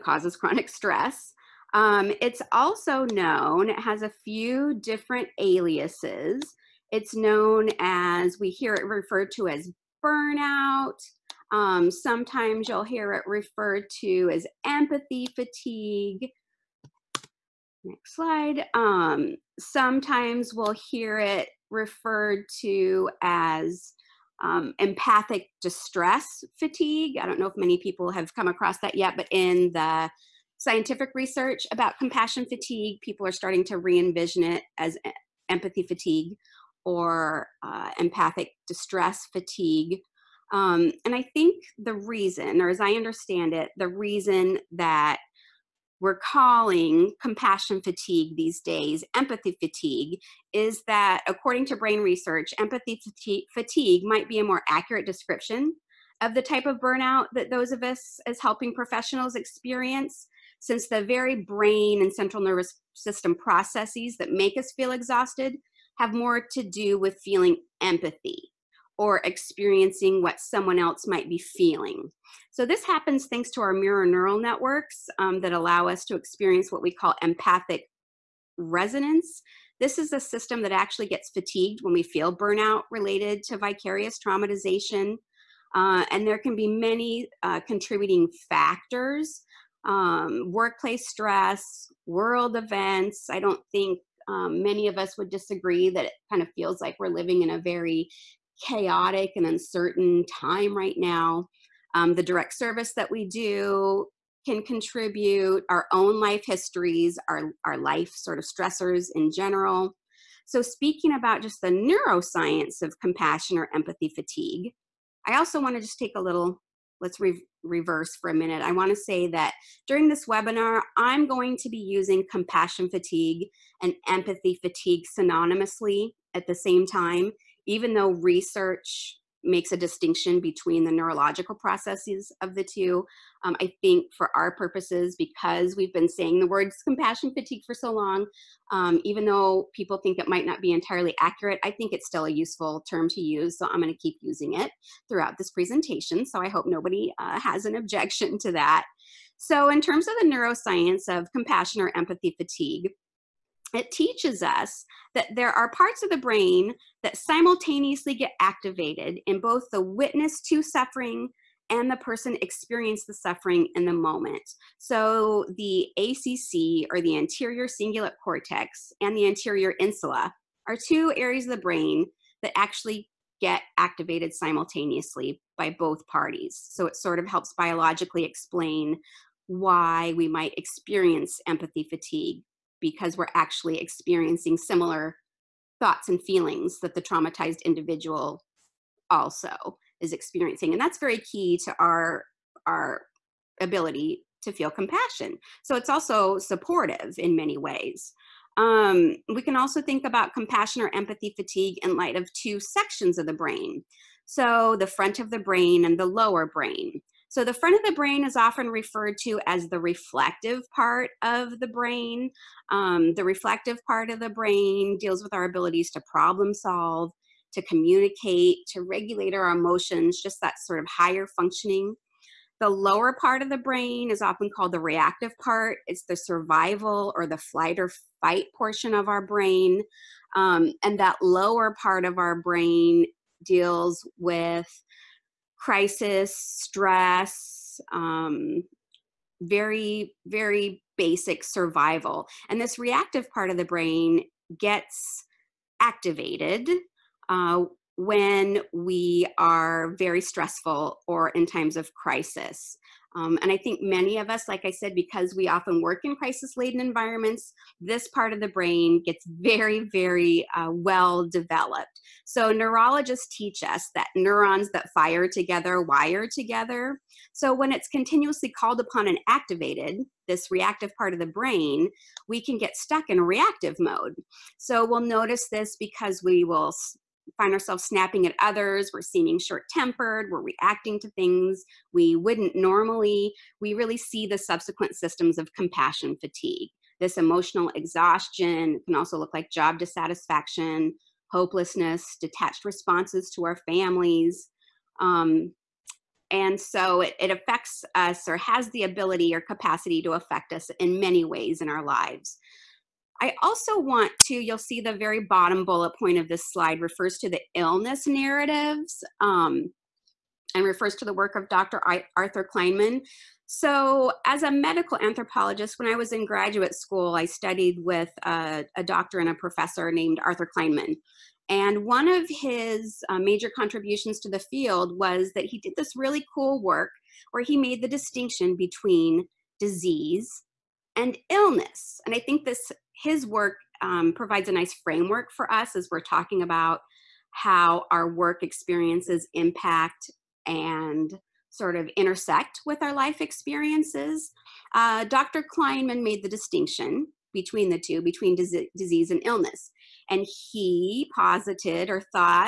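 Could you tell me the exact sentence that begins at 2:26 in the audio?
So I hope nobody uh, has an objection to that.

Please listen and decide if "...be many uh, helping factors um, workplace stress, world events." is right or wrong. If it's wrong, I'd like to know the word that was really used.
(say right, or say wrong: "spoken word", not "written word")
wrong: "contributing", not "helping".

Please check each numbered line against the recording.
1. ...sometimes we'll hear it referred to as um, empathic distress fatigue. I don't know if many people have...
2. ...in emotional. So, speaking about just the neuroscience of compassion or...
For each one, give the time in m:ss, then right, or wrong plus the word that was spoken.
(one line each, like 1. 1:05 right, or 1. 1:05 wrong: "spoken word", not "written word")
1. 0:19 right
2. 1:49 wrong: "general", not "emotional".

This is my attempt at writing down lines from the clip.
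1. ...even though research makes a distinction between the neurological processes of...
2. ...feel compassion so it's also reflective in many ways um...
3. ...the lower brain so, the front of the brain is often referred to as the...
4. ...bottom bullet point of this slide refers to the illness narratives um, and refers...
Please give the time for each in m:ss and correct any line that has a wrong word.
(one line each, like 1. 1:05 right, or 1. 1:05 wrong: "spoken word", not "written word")
1. 2:07 right
2. 3:14 wrong: "supportive", not "reflective"
3. 3:25 right
4. 5:05 right.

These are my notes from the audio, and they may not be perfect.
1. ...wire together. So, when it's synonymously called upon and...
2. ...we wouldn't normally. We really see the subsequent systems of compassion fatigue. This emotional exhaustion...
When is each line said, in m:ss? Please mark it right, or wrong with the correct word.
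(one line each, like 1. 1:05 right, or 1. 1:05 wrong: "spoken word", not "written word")
1. 4:25 wrong: "continuously", not "synonymously"
2. 4:41 right.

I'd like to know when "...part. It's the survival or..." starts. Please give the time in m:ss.
3:45.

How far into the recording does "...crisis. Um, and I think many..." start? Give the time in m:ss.
4:11.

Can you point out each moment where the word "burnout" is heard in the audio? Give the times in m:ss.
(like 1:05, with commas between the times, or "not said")
0:10, 0:56, 1:22.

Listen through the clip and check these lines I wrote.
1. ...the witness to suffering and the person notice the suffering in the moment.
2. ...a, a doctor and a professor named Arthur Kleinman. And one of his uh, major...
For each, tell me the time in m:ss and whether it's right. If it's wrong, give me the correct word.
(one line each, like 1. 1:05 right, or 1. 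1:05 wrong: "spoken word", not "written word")
1. 2:39 wrong: "experience", not "notice"
2. 5:18 right.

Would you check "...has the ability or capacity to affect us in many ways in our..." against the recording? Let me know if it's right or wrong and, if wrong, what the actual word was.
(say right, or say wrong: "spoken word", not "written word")
right.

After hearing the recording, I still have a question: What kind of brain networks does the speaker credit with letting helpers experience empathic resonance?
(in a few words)
mirror neural networks.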